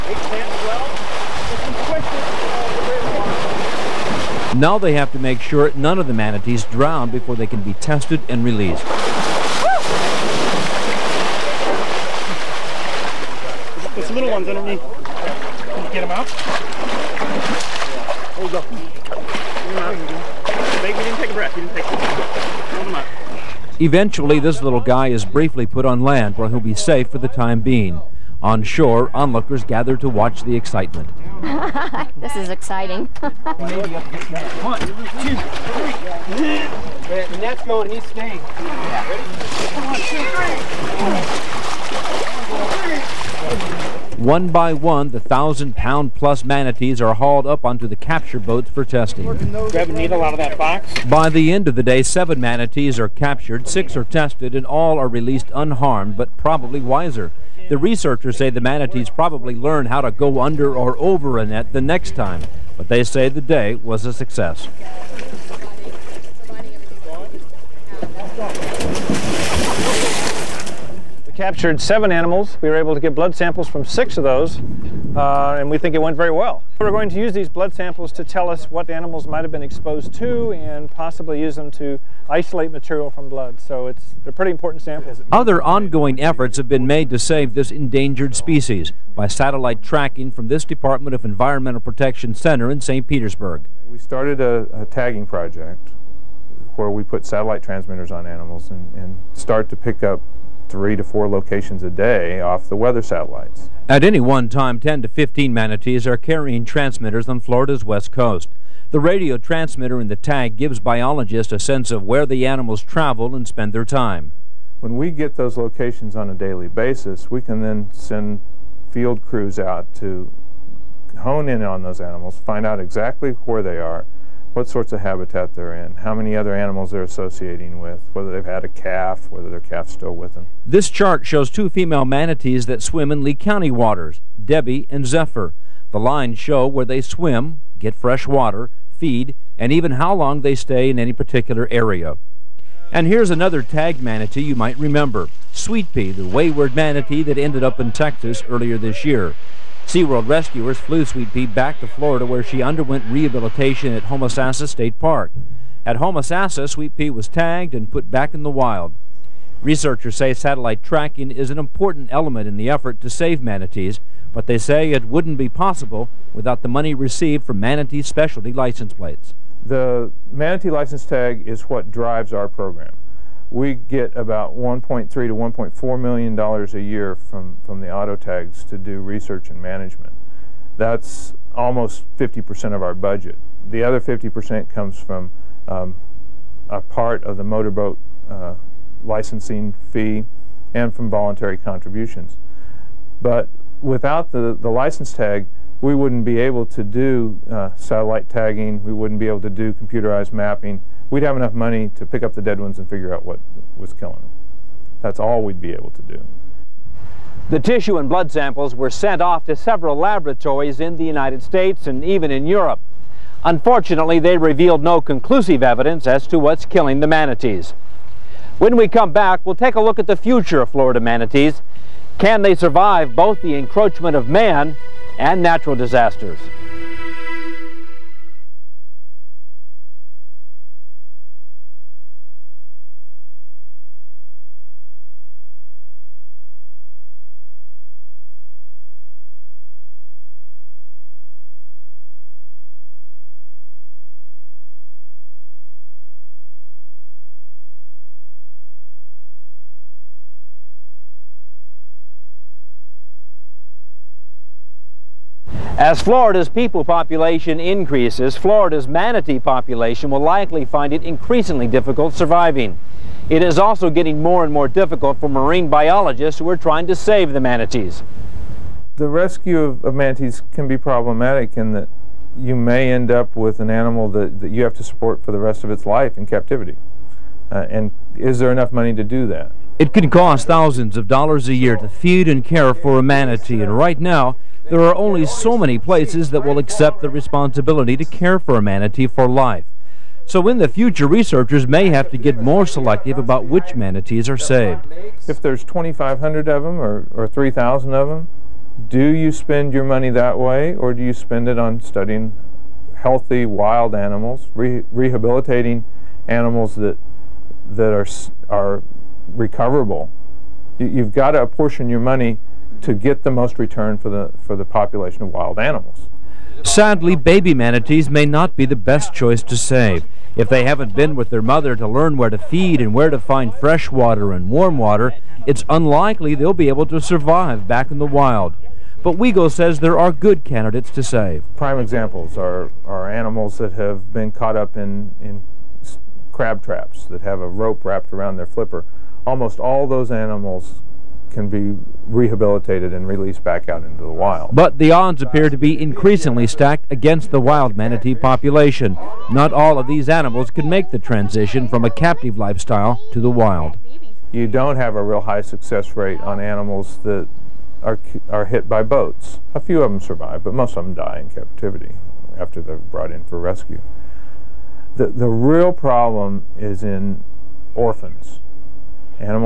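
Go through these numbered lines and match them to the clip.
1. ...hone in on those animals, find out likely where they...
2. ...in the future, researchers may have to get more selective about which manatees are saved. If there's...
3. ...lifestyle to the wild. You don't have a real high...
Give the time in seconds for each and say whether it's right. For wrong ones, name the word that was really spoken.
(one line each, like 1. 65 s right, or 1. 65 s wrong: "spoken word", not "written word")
1. 121 s wrong: "exactly", not "likely"
2. 290 s right
3. 352 s right.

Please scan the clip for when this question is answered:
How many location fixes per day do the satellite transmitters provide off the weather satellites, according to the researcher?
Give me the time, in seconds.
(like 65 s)
100 s.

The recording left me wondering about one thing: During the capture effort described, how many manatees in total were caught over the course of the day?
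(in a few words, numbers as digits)
7.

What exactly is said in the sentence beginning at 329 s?
But Weigel says there are good candidates to save.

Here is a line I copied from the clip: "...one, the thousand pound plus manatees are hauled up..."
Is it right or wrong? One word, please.
right.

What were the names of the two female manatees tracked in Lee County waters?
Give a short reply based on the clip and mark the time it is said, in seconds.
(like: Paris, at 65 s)
Debbie and Zephyr, at 134 s.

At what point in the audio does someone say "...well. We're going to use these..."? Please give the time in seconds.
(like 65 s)
76 s.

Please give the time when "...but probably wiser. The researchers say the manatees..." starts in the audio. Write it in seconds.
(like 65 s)
56 s.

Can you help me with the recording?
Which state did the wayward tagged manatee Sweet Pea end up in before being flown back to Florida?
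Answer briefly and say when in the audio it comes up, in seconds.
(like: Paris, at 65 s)
Texas, at 147 s.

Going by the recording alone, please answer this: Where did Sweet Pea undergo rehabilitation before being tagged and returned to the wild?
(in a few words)
Homosassa State Park.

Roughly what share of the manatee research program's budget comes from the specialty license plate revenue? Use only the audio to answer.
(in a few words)
50%.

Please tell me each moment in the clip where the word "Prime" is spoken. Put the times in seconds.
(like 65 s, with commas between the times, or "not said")
331 s.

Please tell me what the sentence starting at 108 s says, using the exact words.
The radio transmitter in the tag gives biologists a sense of where the animals travel and spend their time.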